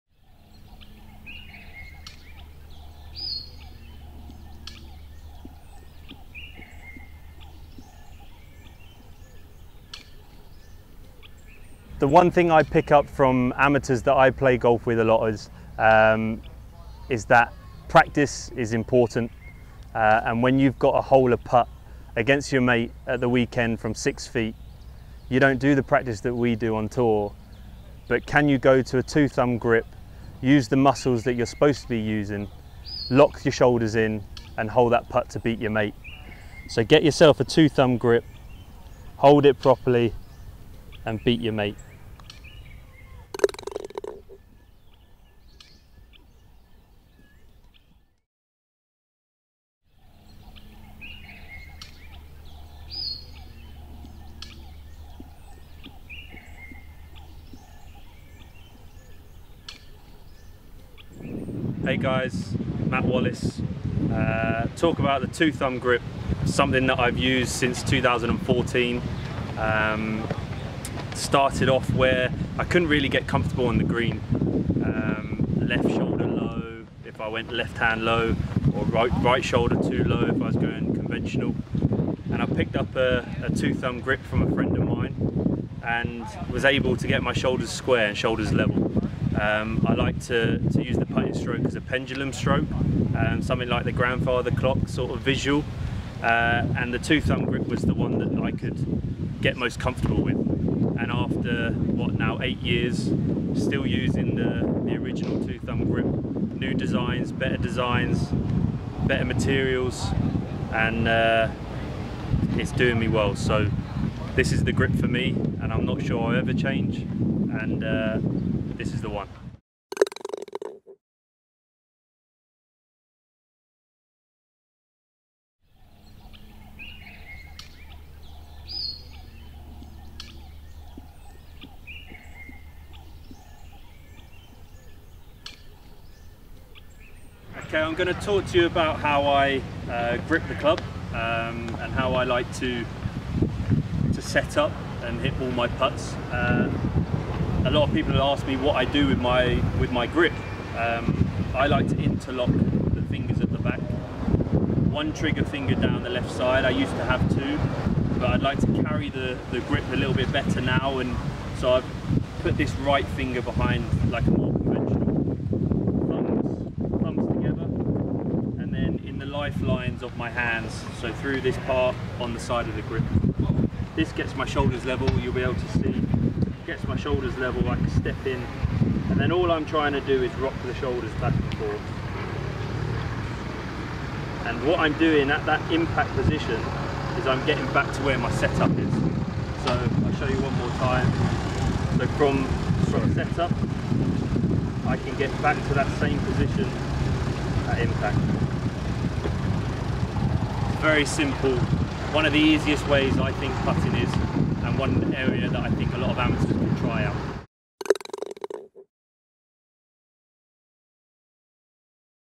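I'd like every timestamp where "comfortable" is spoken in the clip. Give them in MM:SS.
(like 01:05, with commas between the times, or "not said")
01:13, 01:39.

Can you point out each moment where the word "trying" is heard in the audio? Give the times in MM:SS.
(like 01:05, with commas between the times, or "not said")
02:59.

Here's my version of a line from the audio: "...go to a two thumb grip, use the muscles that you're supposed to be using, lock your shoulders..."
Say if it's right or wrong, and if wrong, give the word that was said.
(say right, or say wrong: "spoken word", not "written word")
right.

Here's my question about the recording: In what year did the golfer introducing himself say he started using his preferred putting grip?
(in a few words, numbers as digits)
2014.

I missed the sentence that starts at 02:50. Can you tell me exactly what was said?
So through this part on the side of the grip.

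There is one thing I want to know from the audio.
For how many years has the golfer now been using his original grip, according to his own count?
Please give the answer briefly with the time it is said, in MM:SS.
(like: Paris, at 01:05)
8, at 01:42.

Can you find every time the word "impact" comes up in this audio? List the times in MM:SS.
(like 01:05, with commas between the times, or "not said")
03:05, 03:17.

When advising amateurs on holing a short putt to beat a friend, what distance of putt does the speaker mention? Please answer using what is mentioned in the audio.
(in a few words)
6 feet.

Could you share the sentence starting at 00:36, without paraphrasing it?
So get yourself a two thumb grip, hold it properly, and beat your mate.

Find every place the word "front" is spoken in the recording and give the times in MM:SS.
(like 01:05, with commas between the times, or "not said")
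not said.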